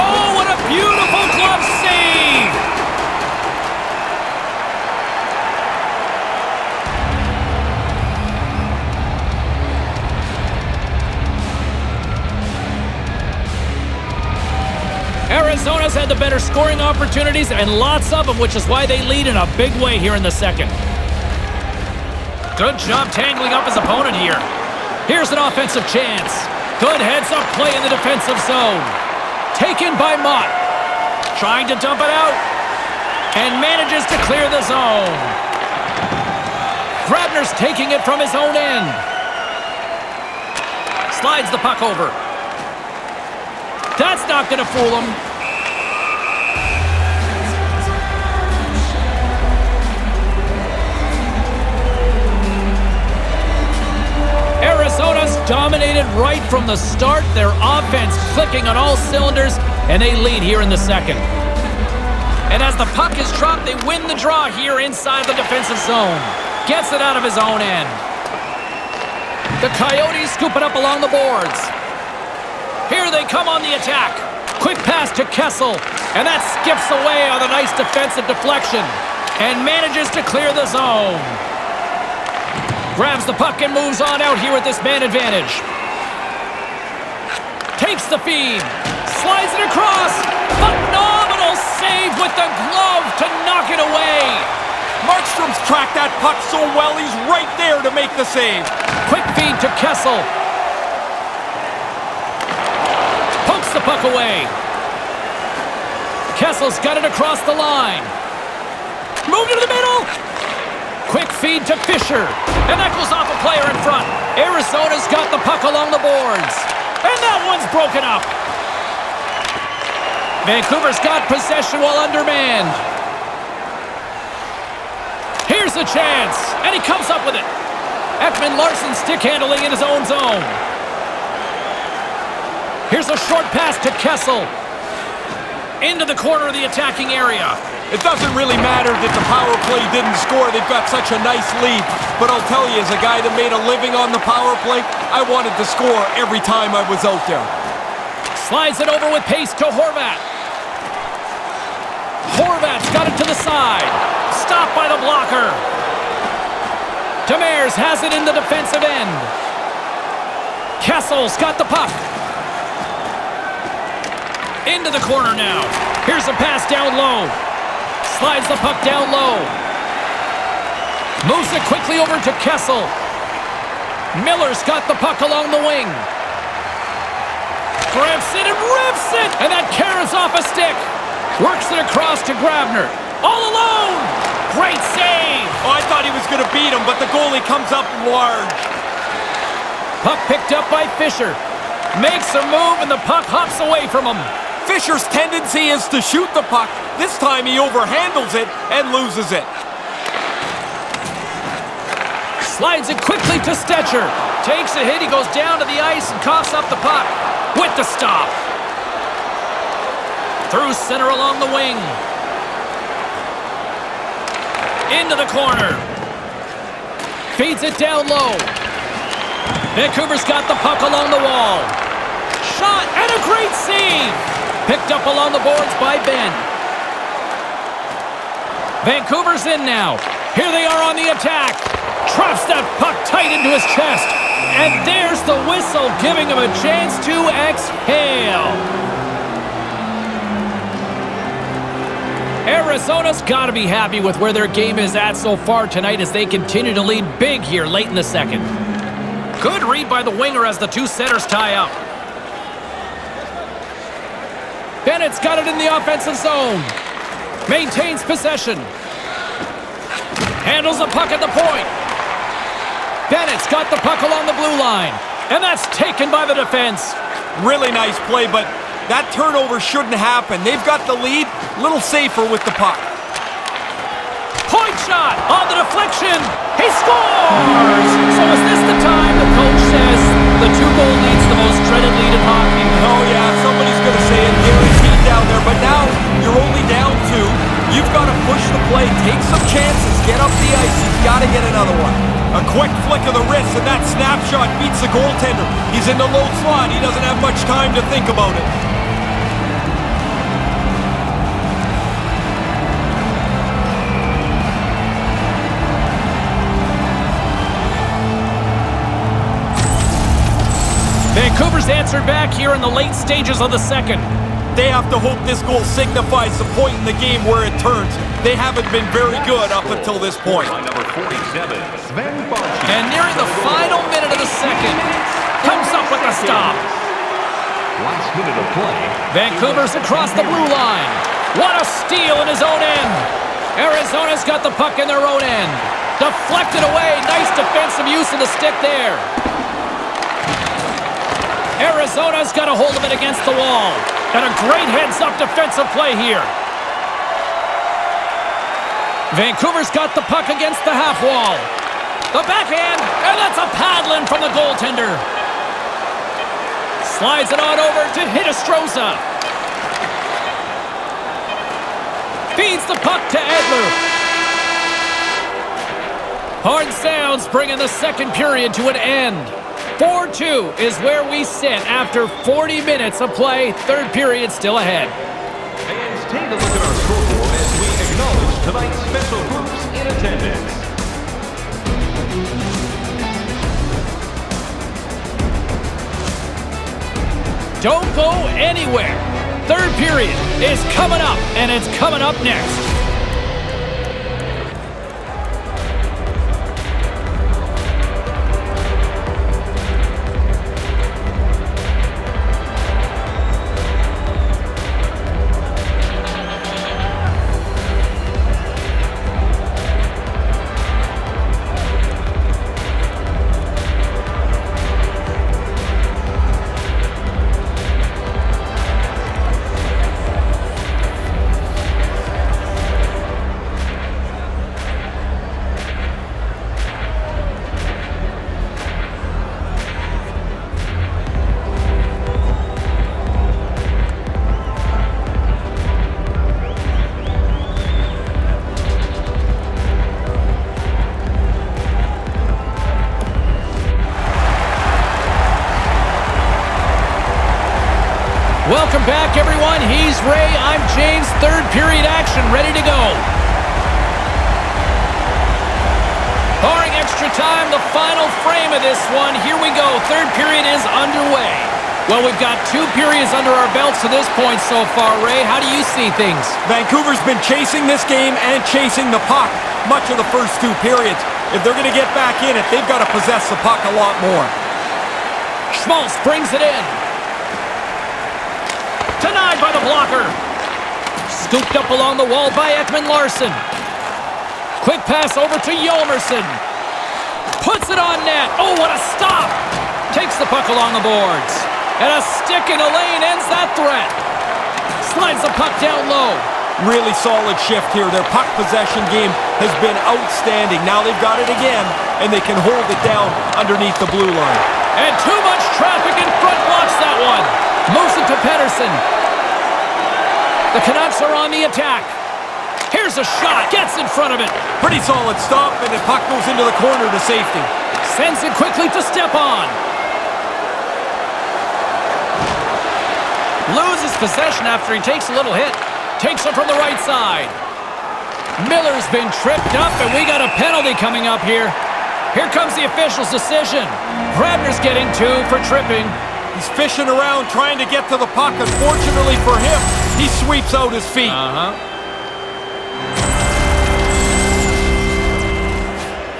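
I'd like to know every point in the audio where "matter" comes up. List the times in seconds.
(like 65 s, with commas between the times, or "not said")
138 s.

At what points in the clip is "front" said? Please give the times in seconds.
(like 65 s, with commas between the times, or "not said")
113 s, 506 s, 513 s.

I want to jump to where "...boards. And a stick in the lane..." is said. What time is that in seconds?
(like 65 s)
490 s.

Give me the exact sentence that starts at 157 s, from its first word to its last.
Demers has it in the defensive end.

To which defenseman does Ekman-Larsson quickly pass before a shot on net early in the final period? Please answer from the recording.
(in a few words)
Hjalmarsson.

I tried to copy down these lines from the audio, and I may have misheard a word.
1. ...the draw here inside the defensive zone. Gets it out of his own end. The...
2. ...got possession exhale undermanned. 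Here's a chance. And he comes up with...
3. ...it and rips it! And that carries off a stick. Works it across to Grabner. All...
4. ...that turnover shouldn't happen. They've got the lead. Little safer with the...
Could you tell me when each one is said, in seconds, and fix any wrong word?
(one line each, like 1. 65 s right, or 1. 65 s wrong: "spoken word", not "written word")
1. 64 s right
2. 120 s wrong: "while", not "exhale"
3. 178 s right
4. 268 s right.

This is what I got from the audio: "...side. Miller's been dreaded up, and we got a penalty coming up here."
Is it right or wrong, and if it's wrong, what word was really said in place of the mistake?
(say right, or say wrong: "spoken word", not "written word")
wrong: "tripped", not "dreaded".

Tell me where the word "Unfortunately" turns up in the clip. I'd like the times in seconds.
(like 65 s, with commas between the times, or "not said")
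538 s.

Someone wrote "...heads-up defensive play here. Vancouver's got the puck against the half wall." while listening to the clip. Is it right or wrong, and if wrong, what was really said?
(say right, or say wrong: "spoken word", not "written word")
right.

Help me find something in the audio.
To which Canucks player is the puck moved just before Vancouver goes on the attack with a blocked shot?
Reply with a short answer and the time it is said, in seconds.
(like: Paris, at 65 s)
Pettersson, at 508 s.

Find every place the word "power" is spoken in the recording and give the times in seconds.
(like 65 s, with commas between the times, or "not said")
139 s, 144 s.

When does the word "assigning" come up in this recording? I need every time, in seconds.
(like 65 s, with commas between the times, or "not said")
not said.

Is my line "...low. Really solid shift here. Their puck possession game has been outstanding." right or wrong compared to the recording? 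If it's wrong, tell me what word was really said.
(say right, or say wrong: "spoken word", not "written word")
right.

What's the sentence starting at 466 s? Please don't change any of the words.
Vancouver's been chasing this game and chasing the puck much of the first two periods.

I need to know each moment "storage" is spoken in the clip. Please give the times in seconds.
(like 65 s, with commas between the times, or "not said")
not said.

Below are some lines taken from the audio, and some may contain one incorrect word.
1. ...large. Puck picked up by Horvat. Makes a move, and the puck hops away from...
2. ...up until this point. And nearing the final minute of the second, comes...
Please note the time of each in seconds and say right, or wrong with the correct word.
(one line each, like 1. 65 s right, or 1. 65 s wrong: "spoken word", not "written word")
1. 188 s wrong: "Fischer", not "Horvat"
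2. 319 s right.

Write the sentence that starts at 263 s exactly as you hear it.
Bennett's got the puck along the blue line.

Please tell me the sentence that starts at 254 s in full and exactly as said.
Bennett's got it in the offensive zone.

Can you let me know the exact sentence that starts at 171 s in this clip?
Moves it quickly over to Kessel.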